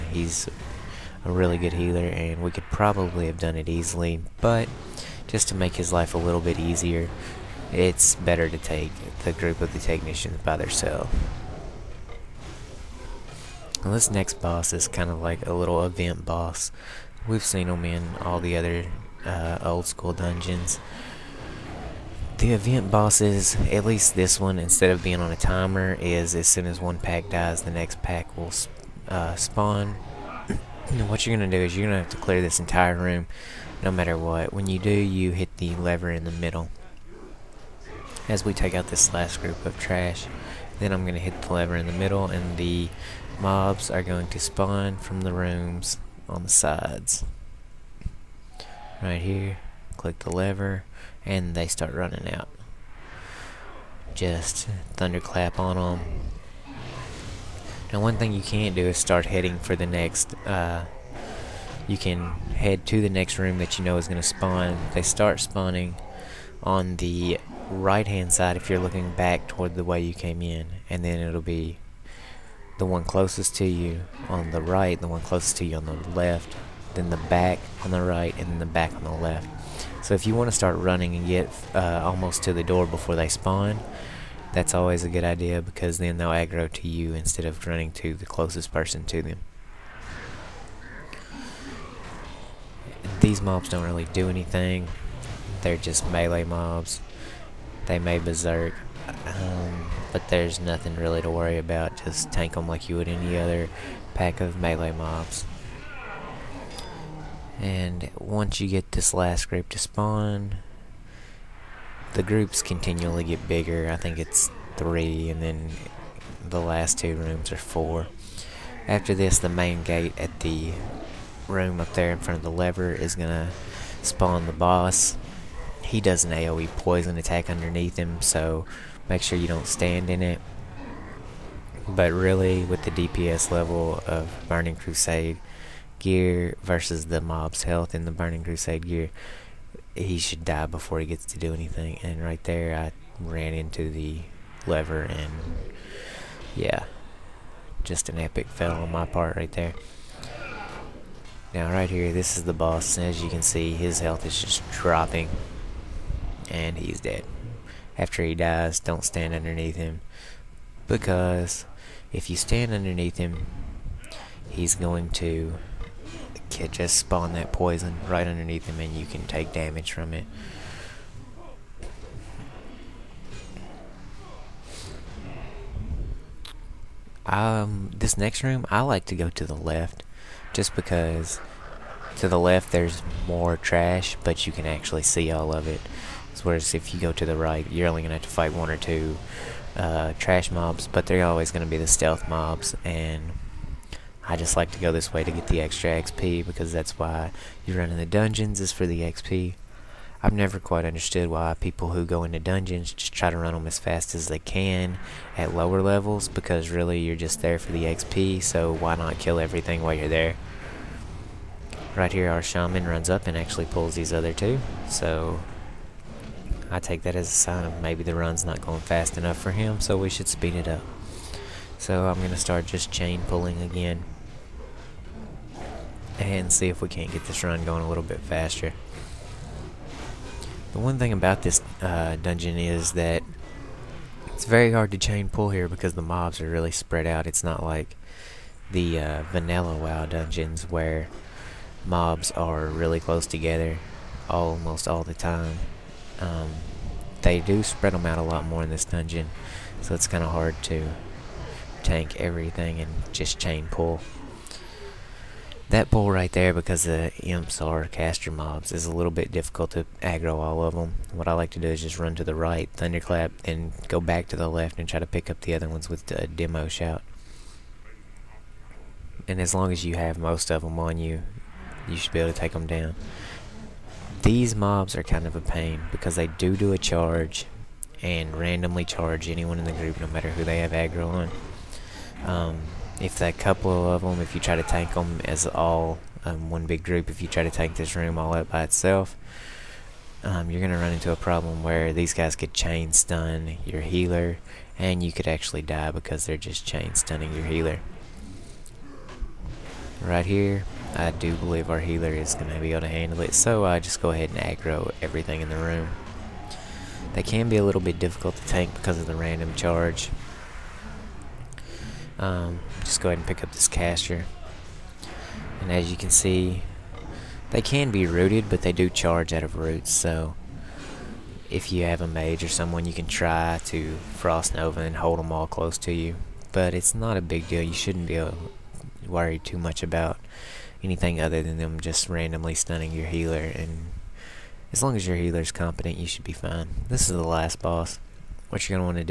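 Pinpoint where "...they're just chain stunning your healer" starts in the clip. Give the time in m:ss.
4:56.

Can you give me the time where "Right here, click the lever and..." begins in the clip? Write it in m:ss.
0:49.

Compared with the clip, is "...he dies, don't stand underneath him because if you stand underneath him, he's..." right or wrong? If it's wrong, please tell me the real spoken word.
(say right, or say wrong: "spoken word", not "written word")
right.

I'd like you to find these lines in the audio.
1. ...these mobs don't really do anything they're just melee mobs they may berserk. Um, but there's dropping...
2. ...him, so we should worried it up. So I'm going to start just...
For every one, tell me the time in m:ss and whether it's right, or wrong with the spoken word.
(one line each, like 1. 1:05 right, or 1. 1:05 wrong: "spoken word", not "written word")
1. 1:33 wrong: "nothing", not "dropping"
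2. 3:39 wrong: "speed", not "worried".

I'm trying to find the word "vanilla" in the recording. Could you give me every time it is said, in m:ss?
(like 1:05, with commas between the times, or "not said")
3:59.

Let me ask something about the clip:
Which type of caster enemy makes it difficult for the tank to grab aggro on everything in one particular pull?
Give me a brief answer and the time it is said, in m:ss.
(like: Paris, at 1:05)
Imps, at 4:17.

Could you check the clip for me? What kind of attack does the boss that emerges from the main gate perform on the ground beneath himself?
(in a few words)
AoE poison attack.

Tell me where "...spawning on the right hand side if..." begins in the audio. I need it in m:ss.
1:05.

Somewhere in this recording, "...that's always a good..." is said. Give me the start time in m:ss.
1:24.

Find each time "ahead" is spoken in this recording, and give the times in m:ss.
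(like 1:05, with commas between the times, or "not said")
5:04, 5:13.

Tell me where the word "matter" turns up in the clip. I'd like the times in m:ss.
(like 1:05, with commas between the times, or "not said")
0:33, 4:40.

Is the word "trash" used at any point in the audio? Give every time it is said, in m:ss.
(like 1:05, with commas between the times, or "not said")
0:39, 3:03, 3:10.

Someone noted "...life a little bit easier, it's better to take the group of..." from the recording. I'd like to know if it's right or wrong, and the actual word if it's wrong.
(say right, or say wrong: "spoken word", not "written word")
right.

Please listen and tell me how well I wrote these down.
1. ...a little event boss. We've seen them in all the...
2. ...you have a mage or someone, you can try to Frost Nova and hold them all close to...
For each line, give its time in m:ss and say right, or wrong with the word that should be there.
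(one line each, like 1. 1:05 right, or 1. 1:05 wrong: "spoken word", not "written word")
1. 0:15 right
2. 5:21 right.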